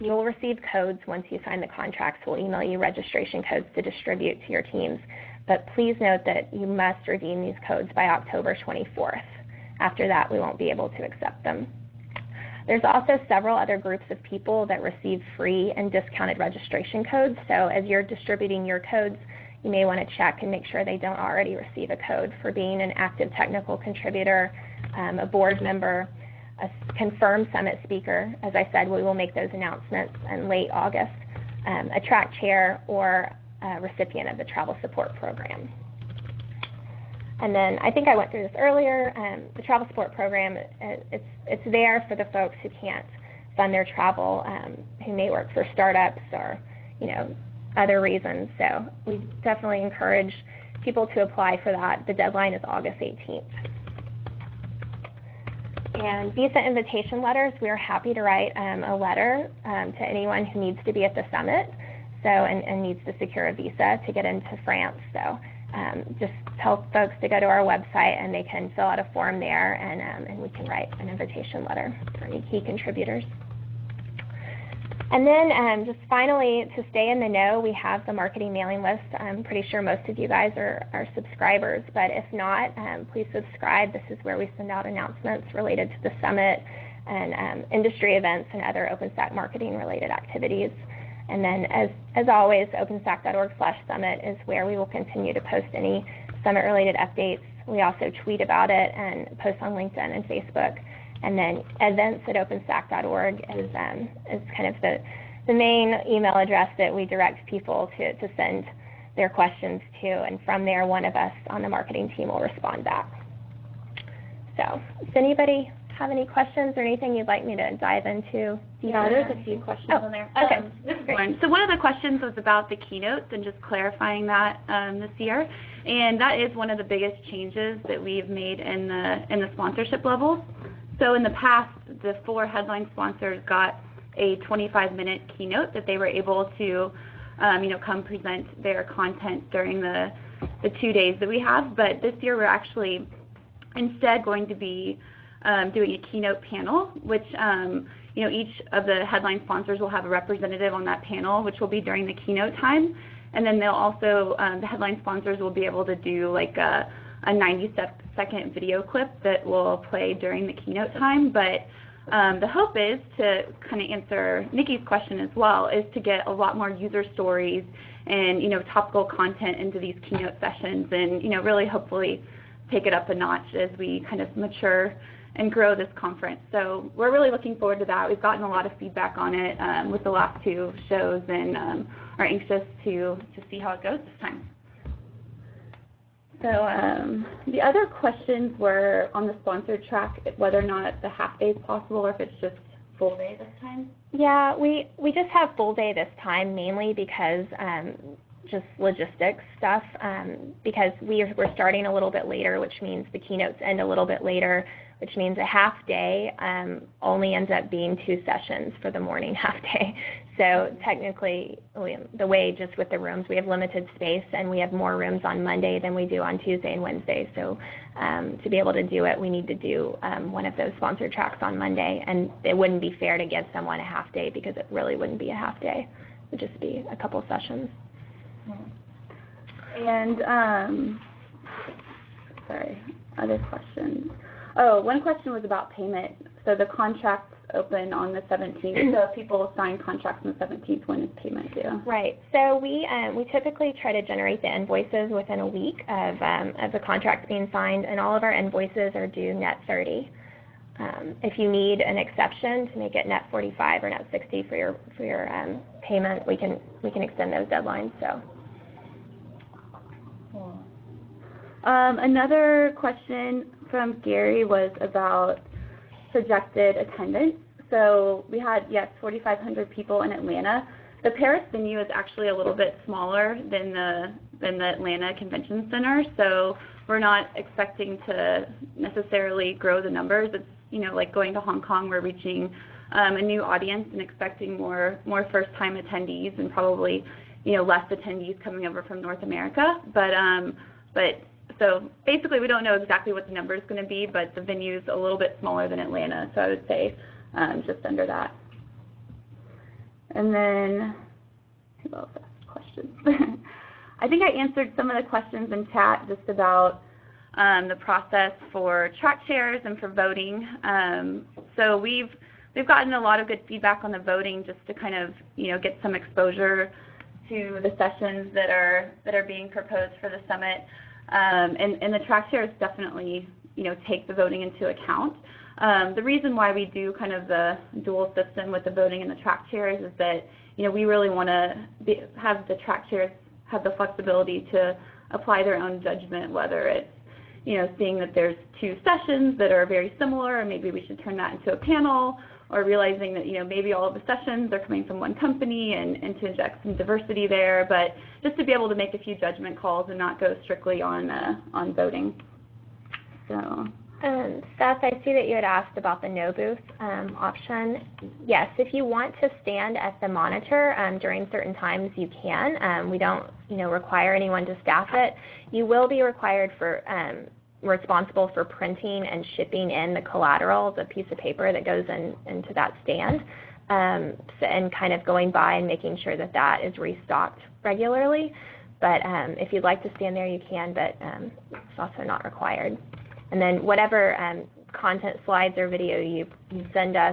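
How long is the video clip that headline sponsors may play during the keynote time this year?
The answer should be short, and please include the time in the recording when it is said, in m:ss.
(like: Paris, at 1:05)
90 seconds, at 2:37.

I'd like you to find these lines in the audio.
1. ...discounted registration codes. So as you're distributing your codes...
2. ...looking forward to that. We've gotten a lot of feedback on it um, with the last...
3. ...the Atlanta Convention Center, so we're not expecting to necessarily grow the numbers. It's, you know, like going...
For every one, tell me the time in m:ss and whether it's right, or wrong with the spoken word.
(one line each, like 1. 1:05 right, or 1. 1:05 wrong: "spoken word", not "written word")
1. 0:15 right
2. 2:57 right
3. 4:34 right.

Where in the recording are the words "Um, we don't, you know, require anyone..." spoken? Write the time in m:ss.
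6:02.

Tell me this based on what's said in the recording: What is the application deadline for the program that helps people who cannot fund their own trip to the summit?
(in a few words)
August 18th.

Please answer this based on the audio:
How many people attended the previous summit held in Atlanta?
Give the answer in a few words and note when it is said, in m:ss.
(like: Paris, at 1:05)
4,500, at 4:28.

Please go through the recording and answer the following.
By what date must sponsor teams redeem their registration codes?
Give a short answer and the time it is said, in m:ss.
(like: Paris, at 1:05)
October 24th, at 0:08.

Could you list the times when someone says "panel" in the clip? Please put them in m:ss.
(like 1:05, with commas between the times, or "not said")
2:26, 2:31, 5:41.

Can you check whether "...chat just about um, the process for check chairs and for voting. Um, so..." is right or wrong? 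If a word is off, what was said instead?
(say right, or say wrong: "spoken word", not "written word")
wrong: "track", not "check".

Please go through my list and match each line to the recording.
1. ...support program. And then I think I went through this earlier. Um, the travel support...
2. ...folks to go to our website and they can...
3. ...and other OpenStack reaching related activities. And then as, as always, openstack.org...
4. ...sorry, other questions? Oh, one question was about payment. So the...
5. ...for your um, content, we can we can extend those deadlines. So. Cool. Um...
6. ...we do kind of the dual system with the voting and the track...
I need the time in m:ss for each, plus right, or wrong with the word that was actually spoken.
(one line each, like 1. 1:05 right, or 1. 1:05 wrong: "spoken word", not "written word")
1. 0:34 right
2. 1:06 right
3. 1:28 wrong: "marketing", not "reaching"
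4. 3:52 right
5. 4:14 wrong: "payment", not "content"
6. 5:26 right.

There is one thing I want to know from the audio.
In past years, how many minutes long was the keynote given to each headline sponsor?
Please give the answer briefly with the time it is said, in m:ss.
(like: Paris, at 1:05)
25, at 2:14.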